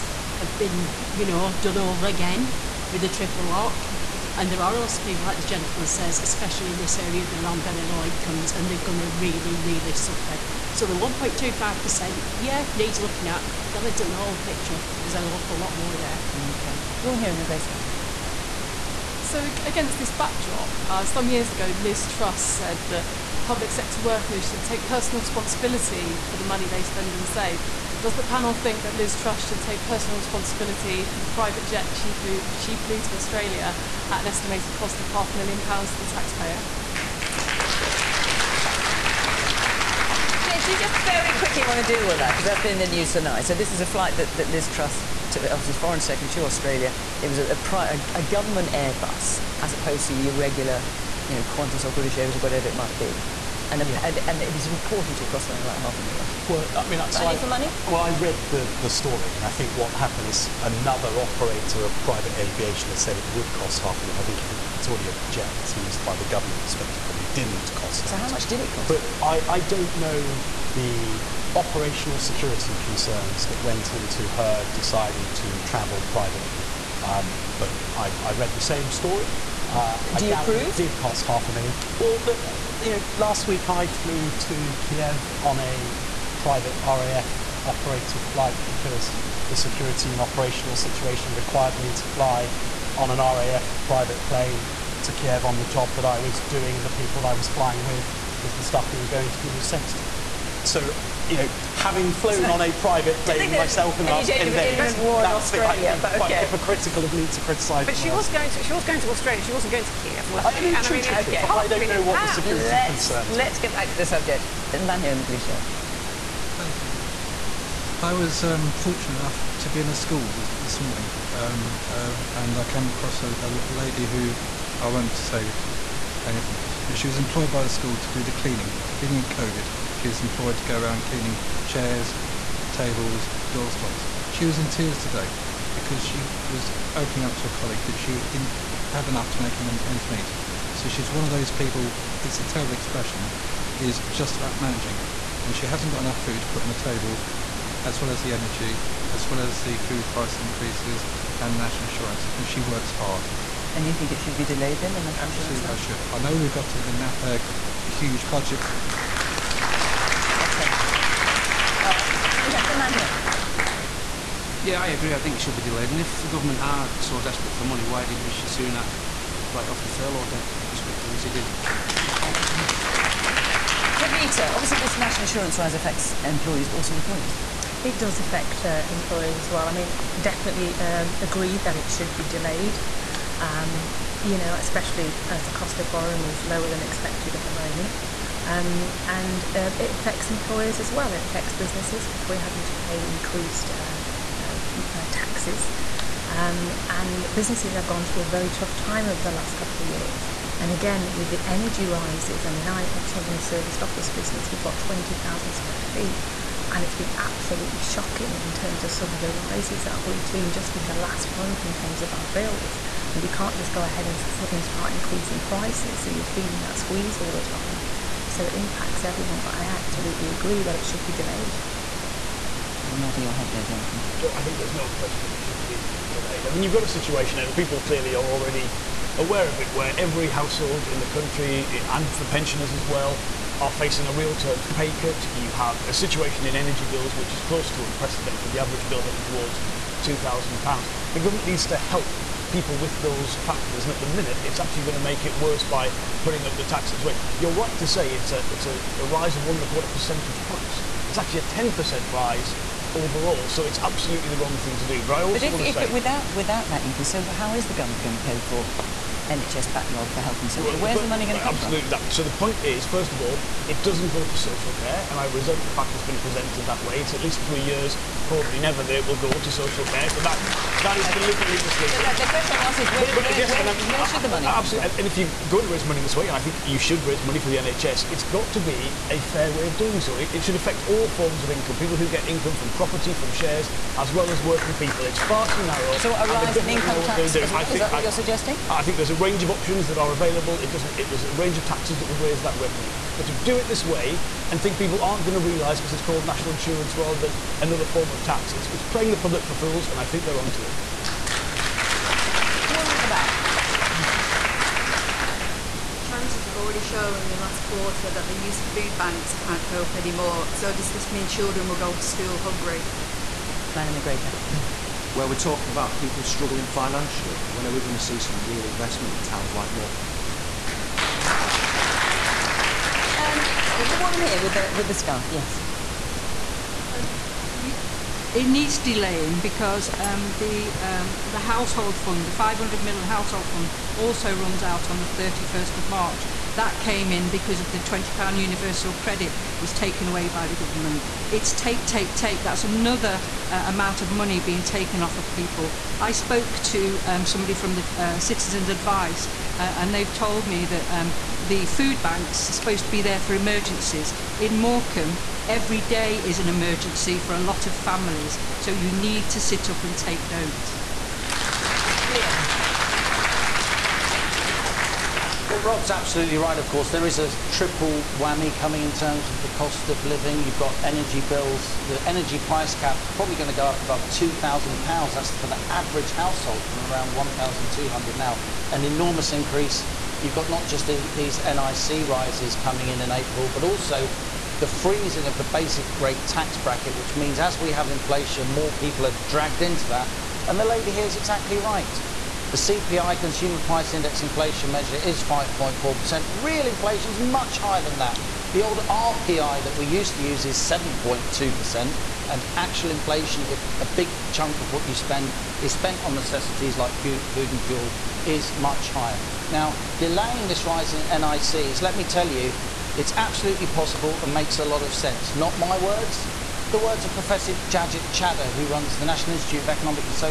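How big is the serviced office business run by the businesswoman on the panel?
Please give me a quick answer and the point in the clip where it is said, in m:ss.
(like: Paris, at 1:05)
20,000 square feet, at 3:24.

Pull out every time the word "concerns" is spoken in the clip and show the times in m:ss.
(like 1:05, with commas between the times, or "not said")
1:12, 1:52.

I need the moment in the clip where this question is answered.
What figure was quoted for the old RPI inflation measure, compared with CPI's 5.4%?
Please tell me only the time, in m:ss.
6:40.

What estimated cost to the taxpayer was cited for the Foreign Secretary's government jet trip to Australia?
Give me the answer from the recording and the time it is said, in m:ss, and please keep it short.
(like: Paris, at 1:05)
half a million pounds, at 0:35.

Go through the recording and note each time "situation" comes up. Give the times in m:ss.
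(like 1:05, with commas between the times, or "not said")
1:30, 3:46, 3:55.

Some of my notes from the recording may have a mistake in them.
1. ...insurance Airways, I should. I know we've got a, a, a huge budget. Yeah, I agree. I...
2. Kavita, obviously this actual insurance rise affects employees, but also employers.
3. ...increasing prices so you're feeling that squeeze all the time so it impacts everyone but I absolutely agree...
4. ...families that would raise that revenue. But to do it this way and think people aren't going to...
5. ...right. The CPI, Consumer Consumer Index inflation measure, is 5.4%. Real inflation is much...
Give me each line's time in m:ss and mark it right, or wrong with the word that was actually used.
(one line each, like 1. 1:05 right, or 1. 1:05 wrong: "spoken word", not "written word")
1. 2:35 wrong: "Absolutely", not "Airways"
2. 2:53 wrong: "national", not "actual"
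3. 3:34 right
4. 4:51 wrong: "taxes", not "families"
5. 6:31 wrong: "Price", not "Consumer".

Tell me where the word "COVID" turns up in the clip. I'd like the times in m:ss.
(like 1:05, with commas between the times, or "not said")
2:09.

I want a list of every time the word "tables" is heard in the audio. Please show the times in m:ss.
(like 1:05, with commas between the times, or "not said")
2:12, 2:26.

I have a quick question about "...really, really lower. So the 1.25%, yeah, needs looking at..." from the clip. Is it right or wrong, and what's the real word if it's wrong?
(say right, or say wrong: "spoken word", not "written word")
wrong: "suffer", not "lower".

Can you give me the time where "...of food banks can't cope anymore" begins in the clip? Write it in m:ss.
5:08.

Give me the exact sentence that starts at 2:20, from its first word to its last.
So she's one of those people, it's a terrible expression, is just about managing.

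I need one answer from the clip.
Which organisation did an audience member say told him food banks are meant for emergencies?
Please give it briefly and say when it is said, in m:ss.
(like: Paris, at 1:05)
Citizens Advice, at 5:48.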